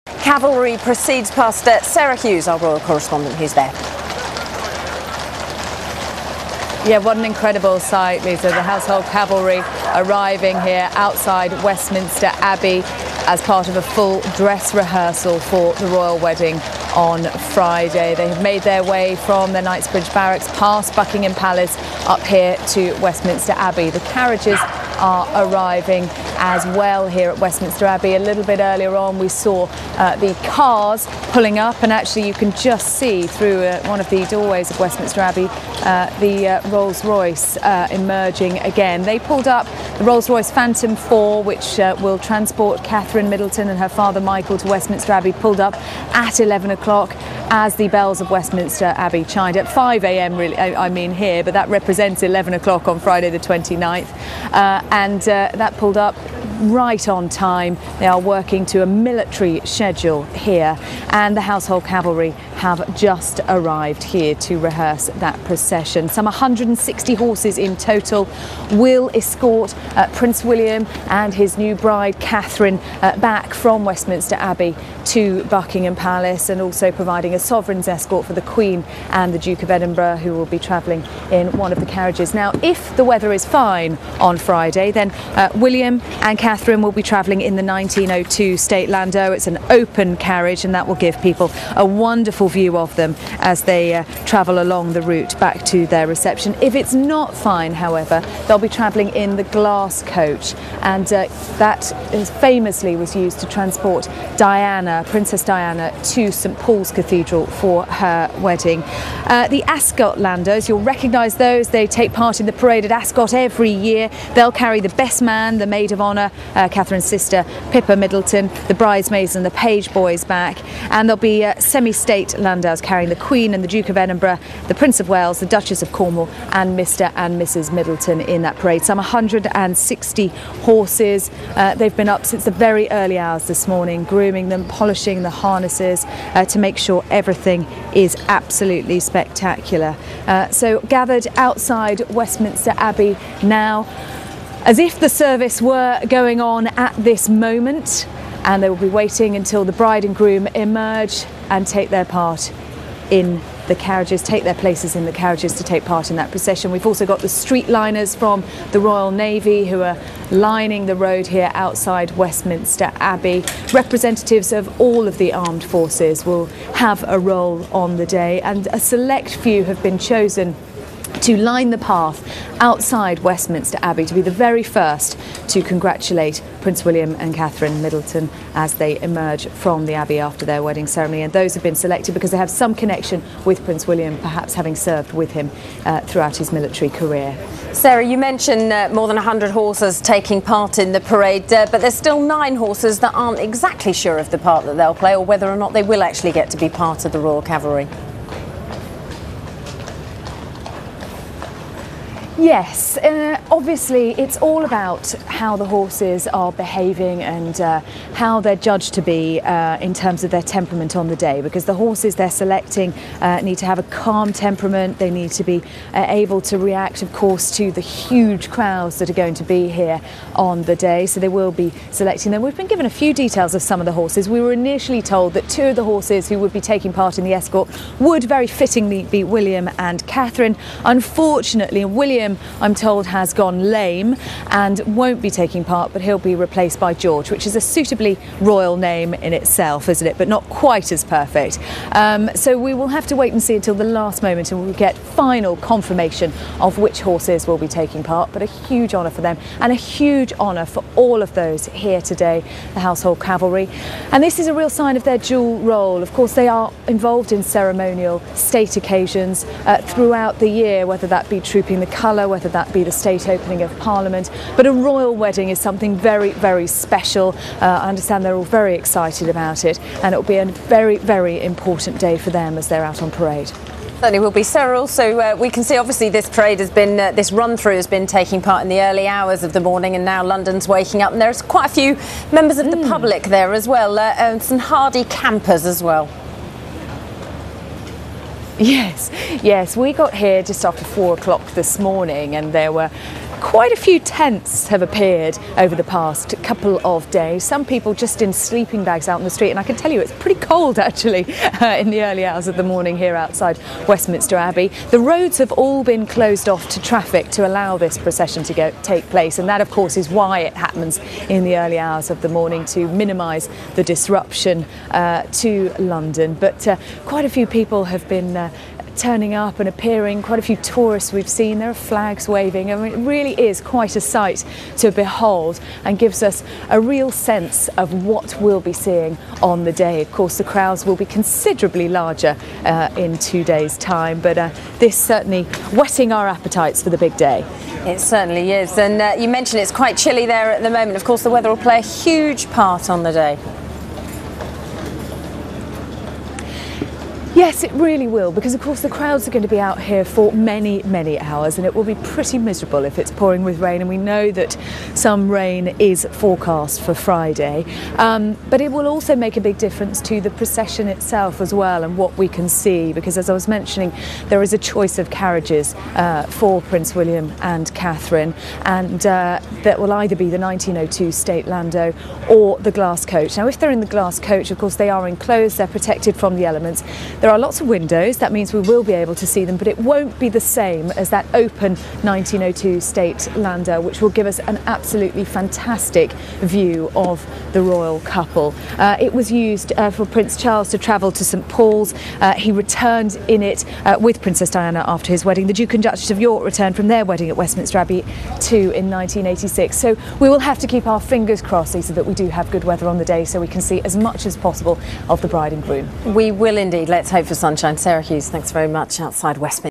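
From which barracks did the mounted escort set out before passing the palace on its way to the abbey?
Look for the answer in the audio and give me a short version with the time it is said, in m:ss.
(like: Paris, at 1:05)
Knightsbridge Barracks, at 0:19.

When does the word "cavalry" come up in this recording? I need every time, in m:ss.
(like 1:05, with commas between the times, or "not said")
0:00, 0:09, 1:01, 3:17, 4:13.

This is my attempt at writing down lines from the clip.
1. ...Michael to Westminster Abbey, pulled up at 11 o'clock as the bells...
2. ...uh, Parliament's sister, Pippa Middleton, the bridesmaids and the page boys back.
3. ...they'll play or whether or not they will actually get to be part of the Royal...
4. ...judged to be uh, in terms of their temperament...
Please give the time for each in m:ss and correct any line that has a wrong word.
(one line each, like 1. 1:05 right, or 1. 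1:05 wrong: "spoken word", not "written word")
1. 0:44 right
2. 1:56 wrong: "Catherine", not "Parliament"
3. 3:14 right
4. 3:28 right.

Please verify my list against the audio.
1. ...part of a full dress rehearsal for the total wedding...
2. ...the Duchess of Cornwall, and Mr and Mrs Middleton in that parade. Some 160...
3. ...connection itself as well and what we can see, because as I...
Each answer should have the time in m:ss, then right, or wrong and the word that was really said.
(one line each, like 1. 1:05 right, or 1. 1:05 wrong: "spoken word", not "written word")
1. 0:13 wrong: "royal", not "total"
2. 2:05 right
3. 6:00 wrong: "procession", not "connection".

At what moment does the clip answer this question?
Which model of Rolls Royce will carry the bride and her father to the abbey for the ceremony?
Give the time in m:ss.
0:40.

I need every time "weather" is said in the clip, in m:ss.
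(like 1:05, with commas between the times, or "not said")
1:23, 5:41, 6:42.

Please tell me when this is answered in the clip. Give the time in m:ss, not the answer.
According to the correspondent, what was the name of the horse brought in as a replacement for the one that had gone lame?
3:56.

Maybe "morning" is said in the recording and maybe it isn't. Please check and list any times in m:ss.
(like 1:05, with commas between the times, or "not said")
2:13, 4:39, 4:51, 5:02, 5:12.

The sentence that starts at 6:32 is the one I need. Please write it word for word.
Uh, he returned in it uh, with Princess Diana after his wedding.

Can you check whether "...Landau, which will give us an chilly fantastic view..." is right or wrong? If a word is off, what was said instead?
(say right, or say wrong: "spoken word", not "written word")
wrong: "absolutely", not "chilly".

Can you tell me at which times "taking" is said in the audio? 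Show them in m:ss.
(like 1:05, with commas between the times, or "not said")
3:10, 3:46, 3:55, 4:07, 4:38.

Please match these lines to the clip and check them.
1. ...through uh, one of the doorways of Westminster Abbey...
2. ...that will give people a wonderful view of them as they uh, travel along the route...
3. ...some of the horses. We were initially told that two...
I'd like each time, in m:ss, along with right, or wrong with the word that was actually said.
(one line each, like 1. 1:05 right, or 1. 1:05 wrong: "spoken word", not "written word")
1. 0:33 right
2. 1:30 right
3. 3:43 right.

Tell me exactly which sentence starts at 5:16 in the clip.
But uh, quite a few people have been uh, uh, turning up and appearing.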